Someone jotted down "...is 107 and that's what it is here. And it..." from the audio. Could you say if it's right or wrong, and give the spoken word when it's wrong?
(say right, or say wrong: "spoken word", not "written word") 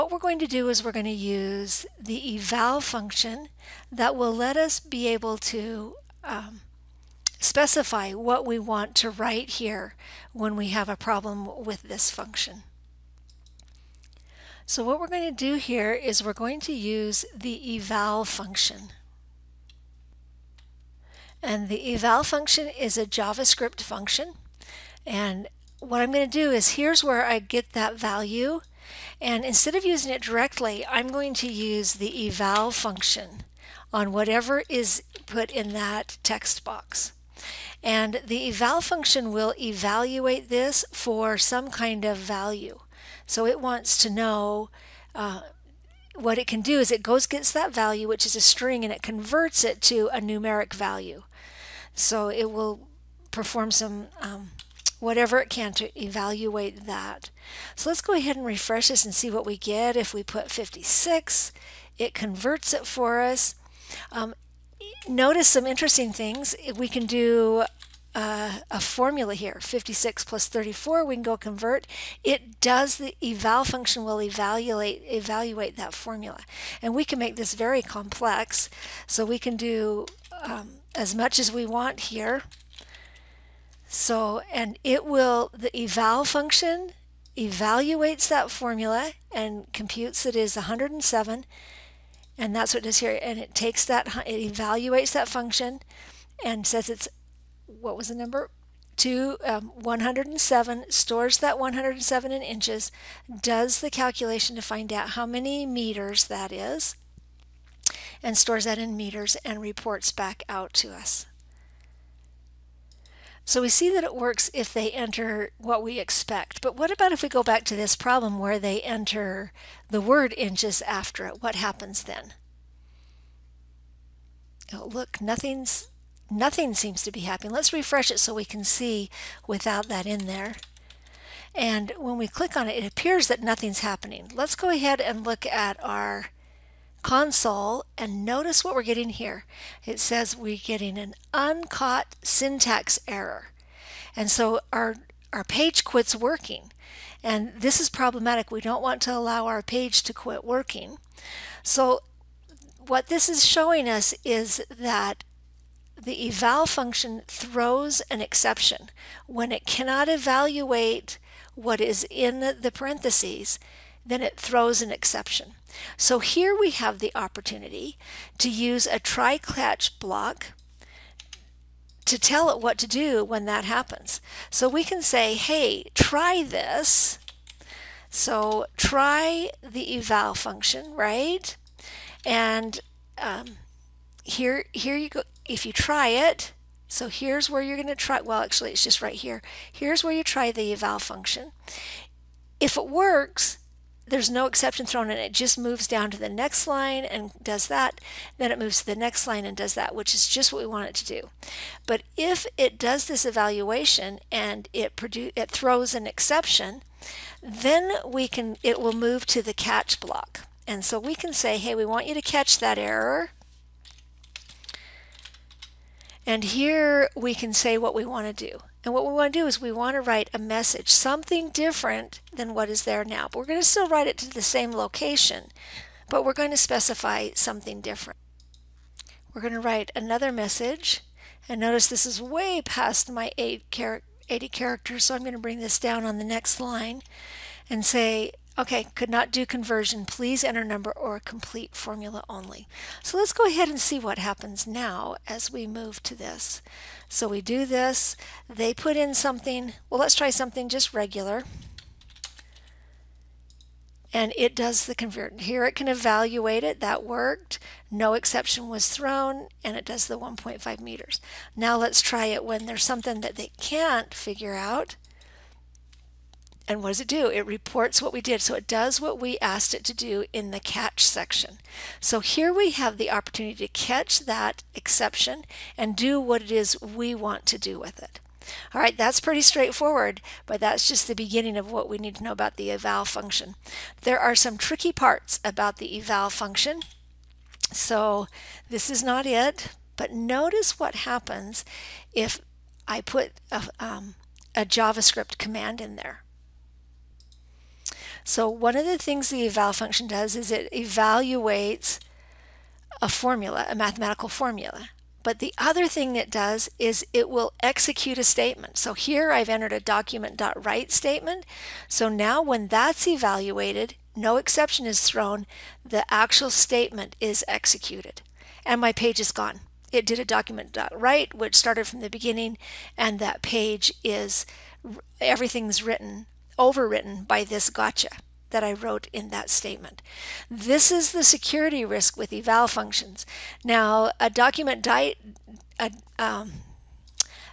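right.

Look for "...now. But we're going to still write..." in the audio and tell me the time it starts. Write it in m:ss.
3:43.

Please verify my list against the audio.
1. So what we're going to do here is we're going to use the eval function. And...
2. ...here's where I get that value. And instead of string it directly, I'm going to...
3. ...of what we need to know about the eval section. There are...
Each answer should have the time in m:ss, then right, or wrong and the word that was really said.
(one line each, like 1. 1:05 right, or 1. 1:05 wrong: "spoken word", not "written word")
1. 0:14 right
2. 0:26 wrong: "using", not "string"
3. 4:41 wrong: "function", not "section".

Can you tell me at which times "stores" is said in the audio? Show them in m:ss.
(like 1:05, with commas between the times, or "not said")
1:40, 1:48.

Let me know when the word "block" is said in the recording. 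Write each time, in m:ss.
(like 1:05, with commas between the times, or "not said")
2:49, 3:29.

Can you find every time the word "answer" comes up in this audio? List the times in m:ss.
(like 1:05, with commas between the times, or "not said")
not said.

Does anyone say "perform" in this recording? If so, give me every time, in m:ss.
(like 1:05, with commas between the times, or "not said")
0:53.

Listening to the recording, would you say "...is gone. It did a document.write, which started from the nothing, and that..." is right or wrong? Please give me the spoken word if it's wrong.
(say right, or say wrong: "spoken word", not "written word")
wrong: "beginning", not "nothing".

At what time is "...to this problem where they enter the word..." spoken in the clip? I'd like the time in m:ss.
1:57.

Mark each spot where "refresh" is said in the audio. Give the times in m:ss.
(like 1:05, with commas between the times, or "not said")
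0:58, 2:07.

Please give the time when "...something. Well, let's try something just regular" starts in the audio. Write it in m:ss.
4:09.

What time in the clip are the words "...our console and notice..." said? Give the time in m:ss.
2:15.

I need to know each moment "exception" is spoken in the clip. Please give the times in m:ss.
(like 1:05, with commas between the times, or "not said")
2:38, 2:44, 3:14, 3:26, 4:18, 4:34, 5:14.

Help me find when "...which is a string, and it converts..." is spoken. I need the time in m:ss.
0:48.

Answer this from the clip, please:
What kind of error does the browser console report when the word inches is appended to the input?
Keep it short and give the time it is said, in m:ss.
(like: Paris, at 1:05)
uncaught syntax error, at 2:21.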